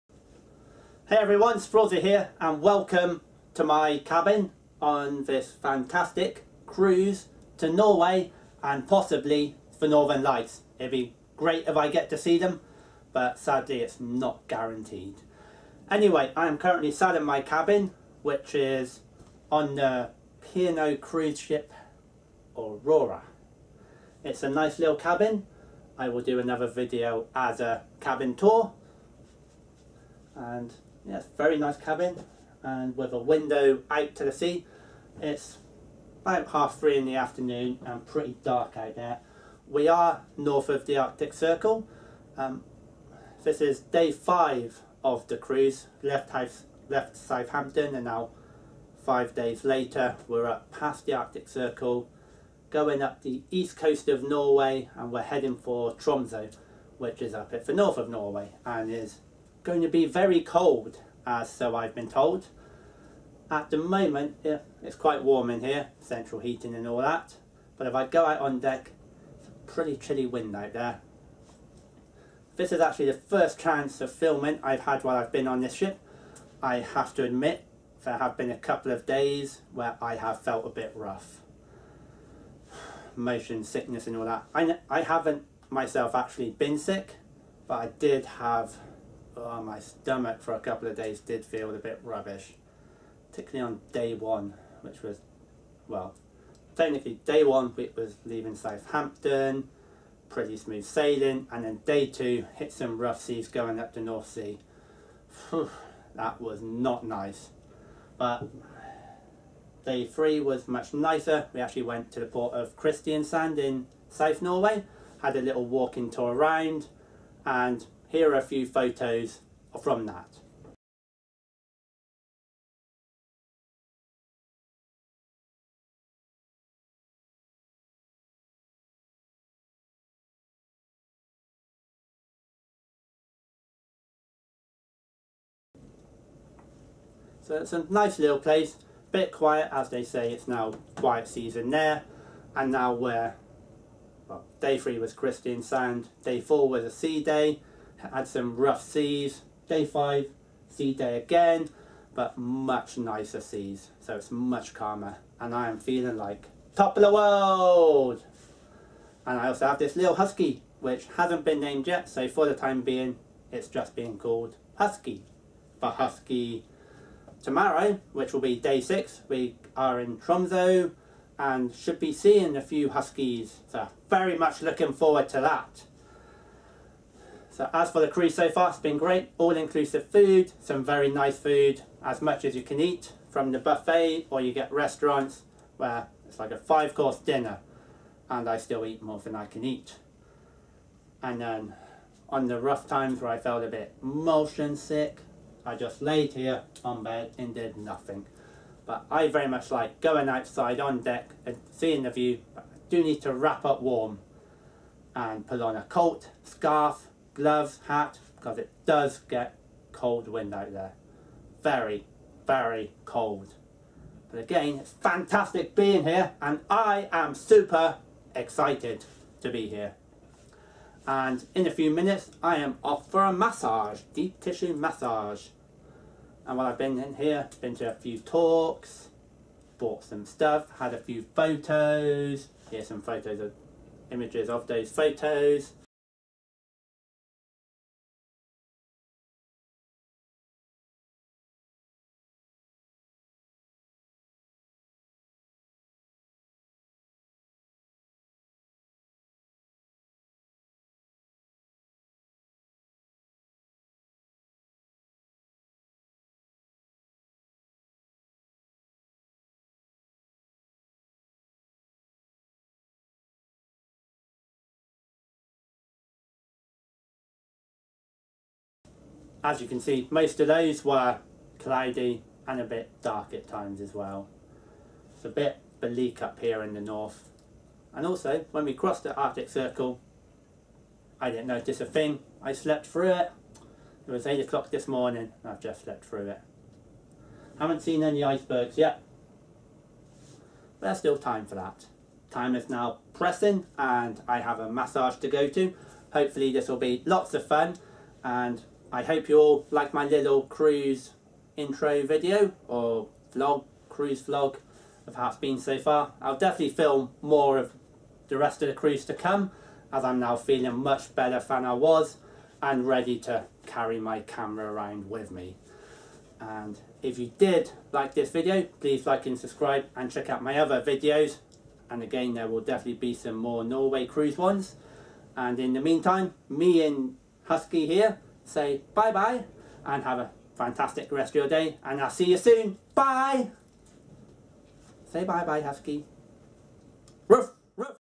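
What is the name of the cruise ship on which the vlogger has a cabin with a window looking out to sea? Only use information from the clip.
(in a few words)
Aurora.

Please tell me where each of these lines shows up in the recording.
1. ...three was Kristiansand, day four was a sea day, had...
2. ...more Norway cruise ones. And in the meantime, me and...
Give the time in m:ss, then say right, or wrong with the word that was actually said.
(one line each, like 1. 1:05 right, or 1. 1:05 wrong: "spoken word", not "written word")
1. 2:24 right
2. 5:23 right.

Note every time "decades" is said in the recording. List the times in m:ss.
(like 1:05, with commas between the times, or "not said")
not said.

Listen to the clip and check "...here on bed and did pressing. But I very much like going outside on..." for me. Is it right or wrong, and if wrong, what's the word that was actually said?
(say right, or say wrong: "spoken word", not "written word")
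wrong: "nothing", not "pressing".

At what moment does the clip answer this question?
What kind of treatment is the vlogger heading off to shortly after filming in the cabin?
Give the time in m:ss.
3:44.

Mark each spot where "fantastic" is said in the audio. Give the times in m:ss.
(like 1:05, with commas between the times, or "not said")
0:05, 3:34, 5:30.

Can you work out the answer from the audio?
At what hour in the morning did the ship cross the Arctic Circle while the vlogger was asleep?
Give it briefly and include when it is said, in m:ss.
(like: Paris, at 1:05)
8 o'clock, at 4:44.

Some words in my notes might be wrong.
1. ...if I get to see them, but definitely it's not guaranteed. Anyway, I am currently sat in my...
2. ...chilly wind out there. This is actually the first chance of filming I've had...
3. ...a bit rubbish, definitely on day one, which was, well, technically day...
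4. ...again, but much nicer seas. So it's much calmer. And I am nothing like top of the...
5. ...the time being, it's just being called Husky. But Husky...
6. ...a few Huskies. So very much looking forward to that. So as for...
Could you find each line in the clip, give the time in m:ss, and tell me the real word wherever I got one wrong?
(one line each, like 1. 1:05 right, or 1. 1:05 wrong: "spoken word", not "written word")
1. 0:11 wrong: "sadly", not "definitely"
2. 1:09 right
3. 1:31 wrong: "particularly", not "definitely"
4. 2:31 wrong: "feeling", not "nothing"
5. 2:42 right
6. 2:52 right.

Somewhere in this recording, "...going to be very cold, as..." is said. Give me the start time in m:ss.
0:59.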